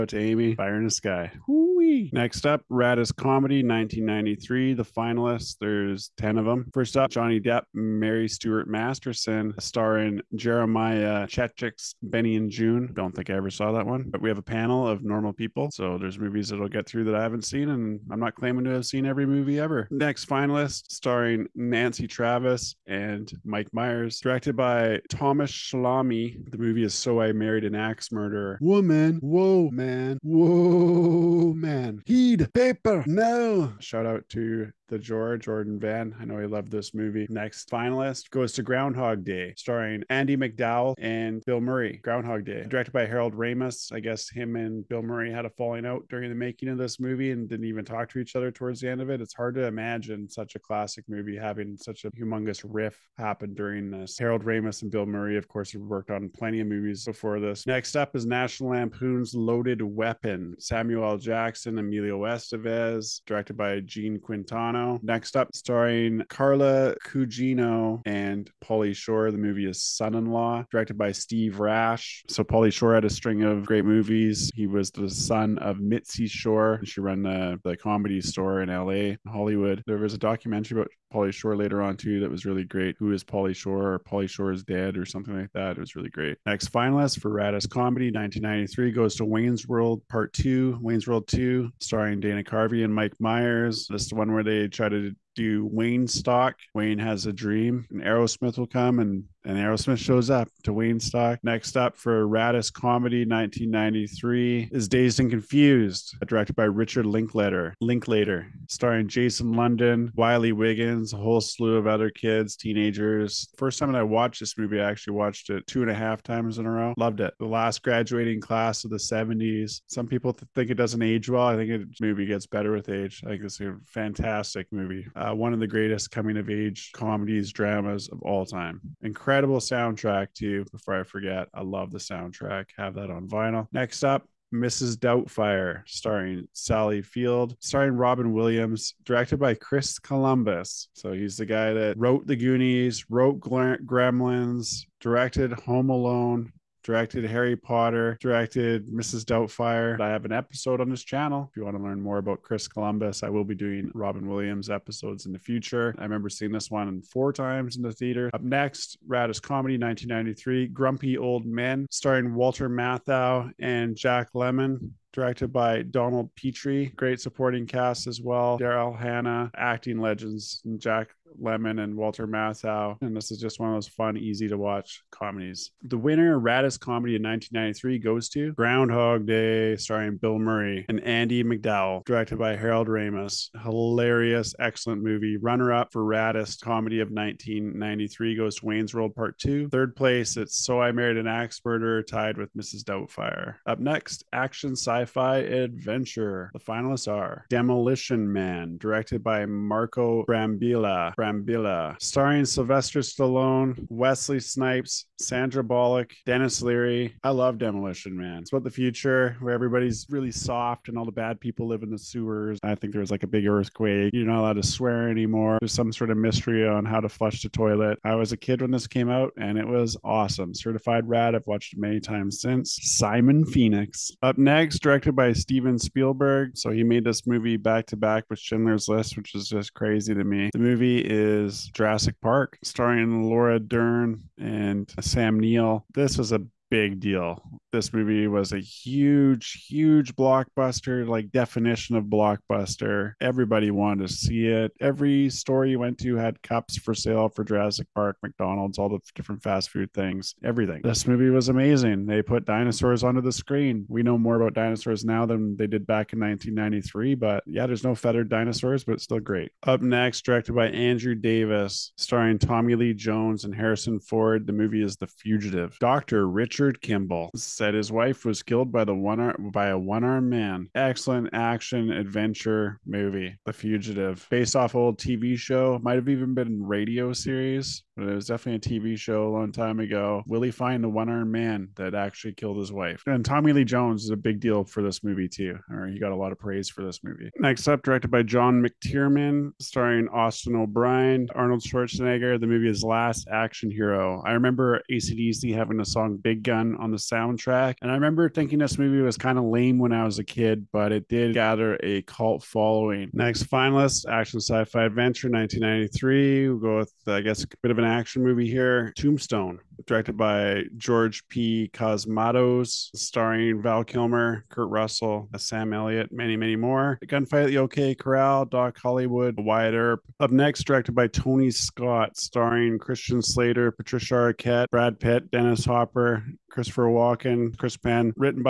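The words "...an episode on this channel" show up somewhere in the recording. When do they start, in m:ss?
2:30.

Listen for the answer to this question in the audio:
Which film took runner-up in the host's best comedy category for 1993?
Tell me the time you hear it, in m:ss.
3:08.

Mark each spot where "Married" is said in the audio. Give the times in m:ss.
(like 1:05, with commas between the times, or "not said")
0:27, 3:10.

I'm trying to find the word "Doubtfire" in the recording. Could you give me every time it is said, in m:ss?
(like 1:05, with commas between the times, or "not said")
2:14, 2:29, 3:12.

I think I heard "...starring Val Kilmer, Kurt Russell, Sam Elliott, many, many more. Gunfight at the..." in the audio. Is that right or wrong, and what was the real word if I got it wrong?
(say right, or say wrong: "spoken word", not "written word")
right.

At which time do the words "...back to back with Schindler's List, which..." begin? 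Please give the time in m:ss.
3:47.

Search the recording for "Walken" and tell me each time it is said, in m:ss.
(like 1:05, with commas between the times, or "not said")
5:26.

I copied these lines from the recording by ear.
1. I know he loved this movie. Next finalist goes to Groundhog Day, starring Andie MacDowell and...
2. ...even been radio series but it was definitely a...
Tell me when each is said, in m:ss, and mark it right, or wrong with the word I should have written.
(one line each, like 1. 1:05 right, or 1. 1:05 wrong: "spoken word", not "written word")
1. 0:36 right
2. 4:36 right.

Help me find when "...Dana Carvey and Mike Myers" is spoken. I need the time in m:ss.
1:32.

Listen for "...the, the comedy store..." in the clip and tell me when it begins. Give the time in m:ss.
1:17.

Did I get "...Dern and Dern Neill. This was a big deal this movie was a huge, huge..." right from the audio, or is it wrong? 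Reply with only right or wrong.
wrong.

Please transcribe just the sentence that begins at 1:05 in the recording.
Next up, starring Carla Gugino and Pauly Shore.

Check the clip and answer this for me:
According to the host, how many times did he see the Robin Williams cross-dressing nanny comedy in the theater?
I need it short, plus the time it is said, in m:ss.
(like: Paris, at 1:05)
4, at 2:37.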